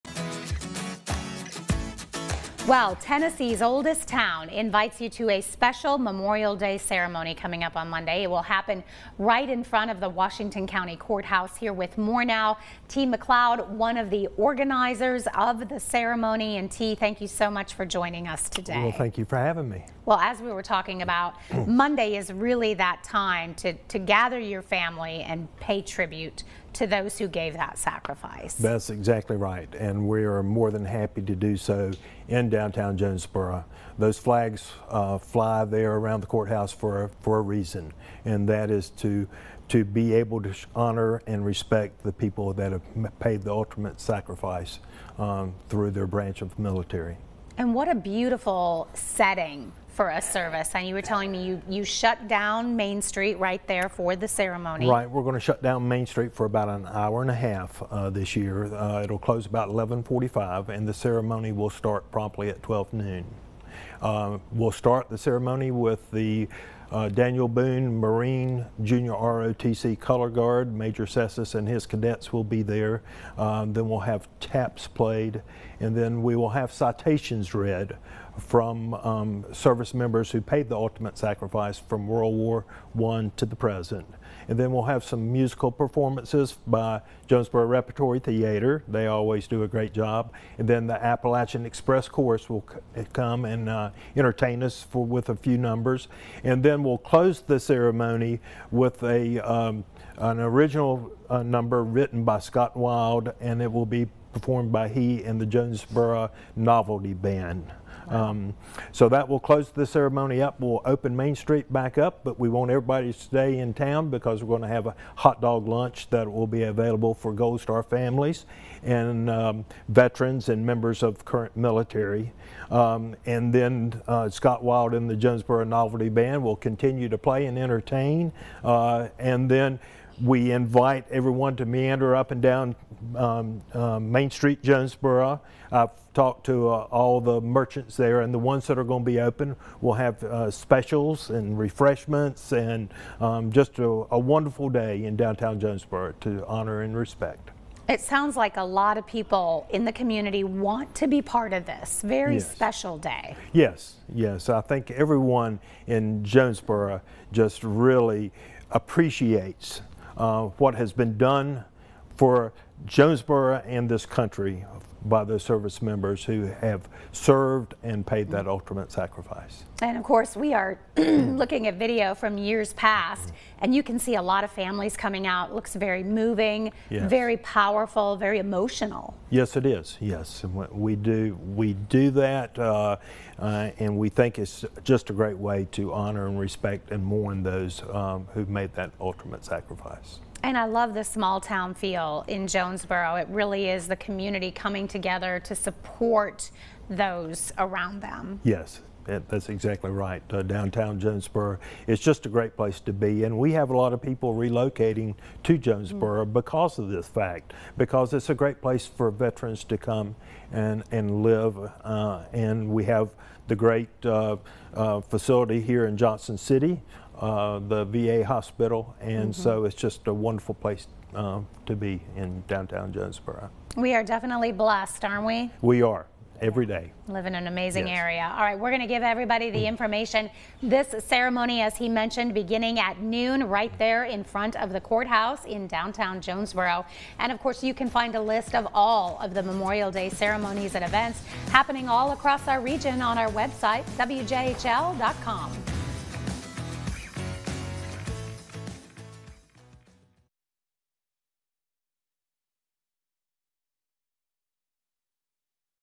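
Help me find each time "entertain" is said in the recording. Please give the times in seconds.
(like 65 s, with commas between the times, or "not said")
94 s, 127 s.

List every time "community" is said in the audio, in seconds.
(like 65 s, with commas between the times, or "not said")
149 s, 193 s.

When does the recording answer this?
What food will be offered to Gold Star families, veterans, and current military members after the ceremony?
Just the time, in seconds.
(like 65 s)
115 s.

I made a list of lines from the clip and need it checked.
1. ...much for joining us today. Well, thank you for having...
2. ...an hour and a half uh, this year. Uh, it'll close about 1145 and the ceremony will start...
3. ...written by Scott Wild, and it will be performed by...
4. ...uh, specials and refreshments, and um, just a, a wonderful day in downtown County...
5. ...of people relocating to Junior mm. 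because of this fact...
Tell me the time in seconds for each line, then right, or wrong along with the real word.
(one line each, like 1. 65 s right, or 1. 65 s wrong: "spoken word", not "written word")
1. 17 s right
2. 56 s right
3. 101 s right
4. 140 s wrong: "Jonesborough", not "County"
5. 203 s wrong: "Jonesborough", not "Junior".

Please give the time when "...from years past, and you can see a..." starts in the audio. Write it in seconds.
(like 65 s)
172 s.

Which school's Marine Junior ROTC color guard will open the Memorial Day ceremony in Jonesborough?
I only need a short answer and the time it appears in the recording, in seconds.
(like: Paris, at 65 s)
Daniel Boone, at 67 s.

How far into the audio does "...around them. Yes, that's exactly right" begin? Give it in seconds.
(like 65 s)
197 s.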